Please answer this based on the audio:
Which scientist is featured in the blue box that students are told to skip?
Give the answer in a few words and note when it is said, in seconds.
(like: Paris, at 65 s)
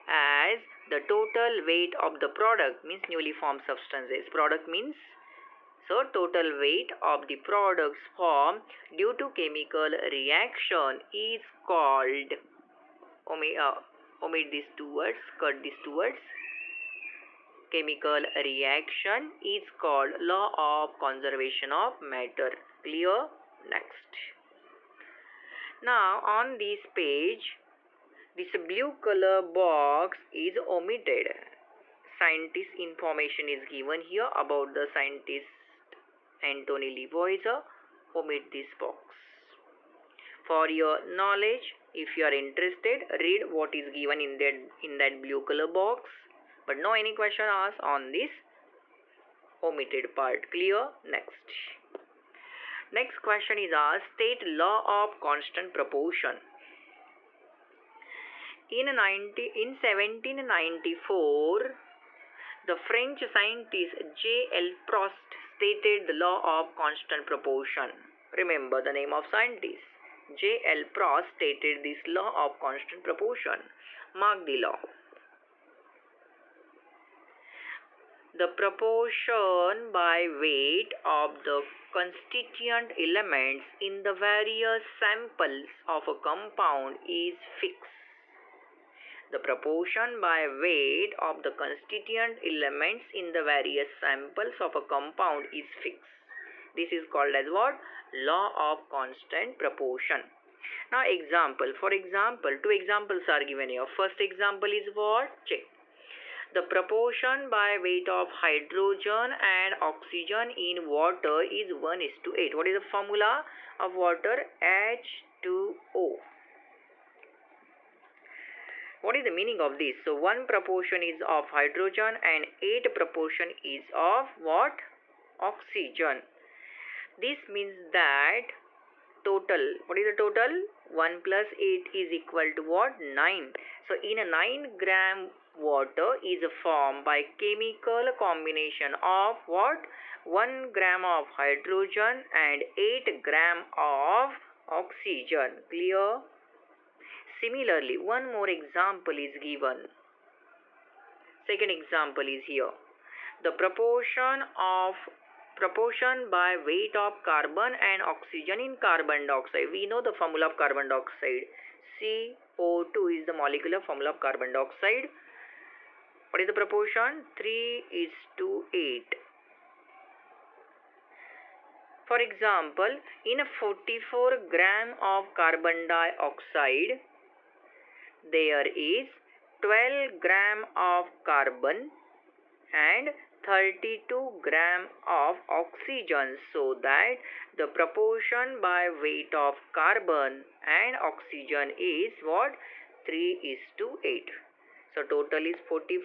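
Antony Lavoisier, at 36 s.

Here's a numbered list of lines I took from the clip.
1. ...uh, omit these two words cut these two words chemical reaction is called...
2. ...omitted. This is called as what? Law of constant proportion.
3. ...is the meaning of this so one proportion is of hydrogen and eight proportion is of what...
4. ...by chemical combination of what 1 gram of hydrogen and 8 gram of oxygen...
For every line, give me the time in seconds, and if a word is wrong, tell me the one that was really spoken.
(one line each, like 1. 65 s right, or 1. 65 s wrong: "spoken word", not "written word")
1. 13 s right
2. 95 s wrong: "fixed", not "omitted"
3. 119 s right
4. 137 s right.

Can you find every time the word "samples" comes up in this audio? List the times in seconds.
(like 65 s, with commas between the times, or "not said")
84 s, 93 s.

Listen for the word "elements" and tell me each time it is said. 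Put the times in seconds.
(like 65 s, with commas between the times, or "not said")
82 s, 92 s.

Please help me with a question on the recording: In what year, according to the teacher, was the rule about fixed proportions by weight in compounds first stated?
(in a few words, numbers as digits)
1794.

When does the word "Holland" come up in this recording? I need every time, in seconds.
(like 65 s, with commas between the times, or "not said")
not said.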